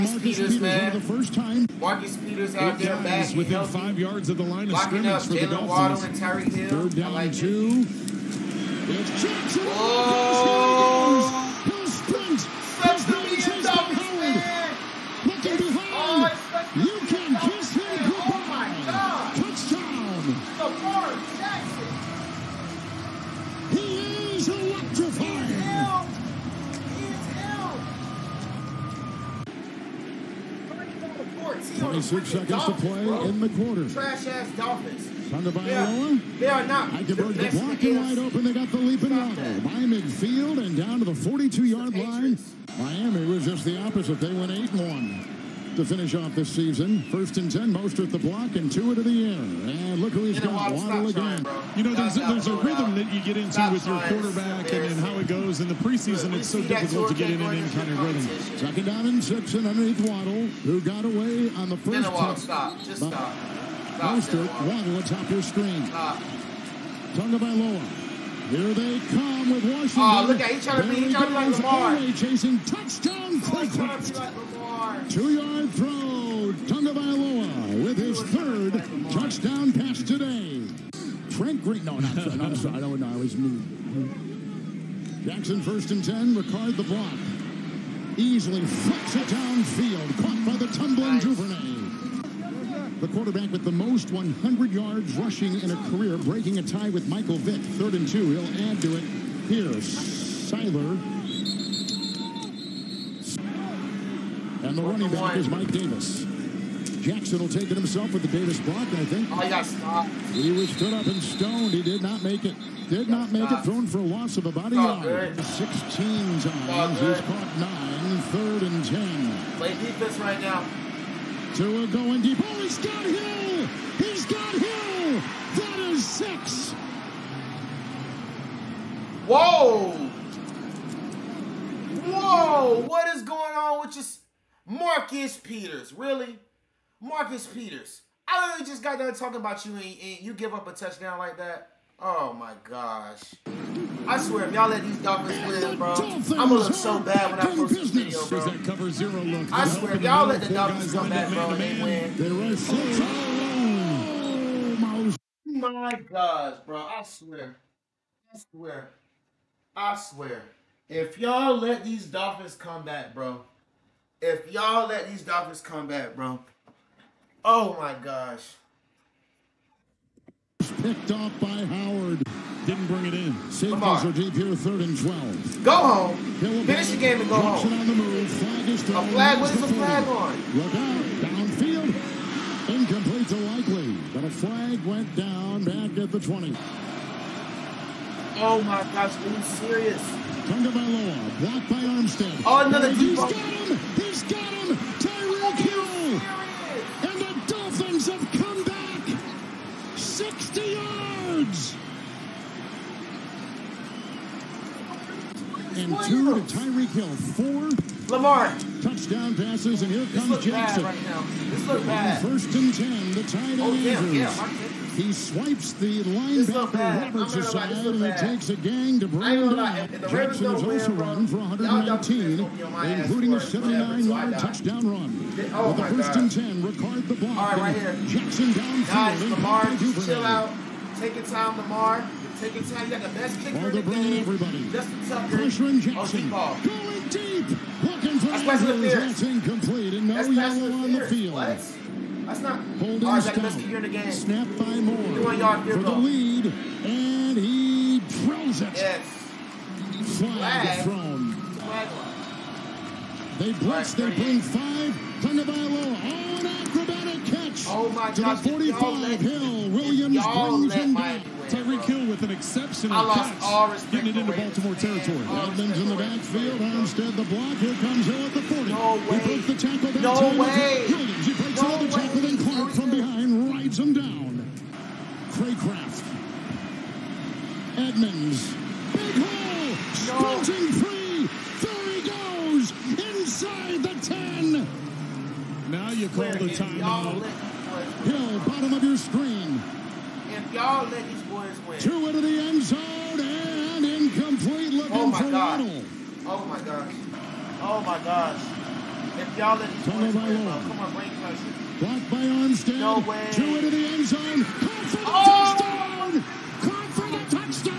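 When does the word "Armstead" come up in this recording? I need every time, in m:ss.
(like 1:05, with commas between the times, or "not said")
3:11, 4:26, 5:02.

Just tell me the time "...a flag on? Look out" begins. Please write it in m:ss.
2:59.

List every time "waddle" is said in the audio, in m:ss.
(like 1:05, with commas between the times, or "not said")
0:05, 0:39, 0:50, 1:00, 1:04, 4:55.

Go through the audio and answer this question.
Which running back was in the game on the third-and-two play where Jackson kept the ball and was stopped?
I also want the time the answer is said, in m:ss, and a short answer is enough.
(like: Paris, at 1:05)
Mike Davis, at 1:45.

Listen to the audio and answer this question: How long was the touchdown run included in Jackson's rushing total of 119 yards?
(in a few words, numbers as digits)
79 yards.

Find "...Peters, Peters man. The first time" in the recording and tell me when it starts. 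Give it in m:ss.
0:00.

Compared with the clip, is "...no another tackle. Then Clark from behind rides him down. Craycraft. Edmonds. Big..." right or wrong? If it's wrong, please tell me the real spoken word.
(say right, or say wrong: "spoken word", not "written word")
right.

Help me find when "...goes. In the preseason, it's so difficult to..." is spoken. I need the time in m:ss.
0:55.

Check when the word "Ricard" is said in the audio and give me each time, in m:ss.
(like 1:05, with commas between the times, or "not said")
1:26, 3:46.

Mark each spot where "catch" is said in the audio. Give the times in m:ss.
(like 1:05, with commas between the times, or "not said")
4:17, 4:23.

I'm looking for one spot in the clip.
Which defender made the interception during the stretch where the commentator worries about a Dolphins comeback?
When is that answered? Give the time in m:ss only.
2:51.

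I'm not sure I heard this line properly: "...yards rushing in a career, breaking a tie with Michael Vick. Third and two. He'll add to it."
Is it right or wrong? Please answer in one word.
right.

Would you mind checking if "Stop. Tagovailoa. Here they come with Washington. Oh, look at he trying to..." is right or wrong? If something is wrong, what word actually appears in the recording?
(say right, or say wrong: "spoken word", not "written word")
right.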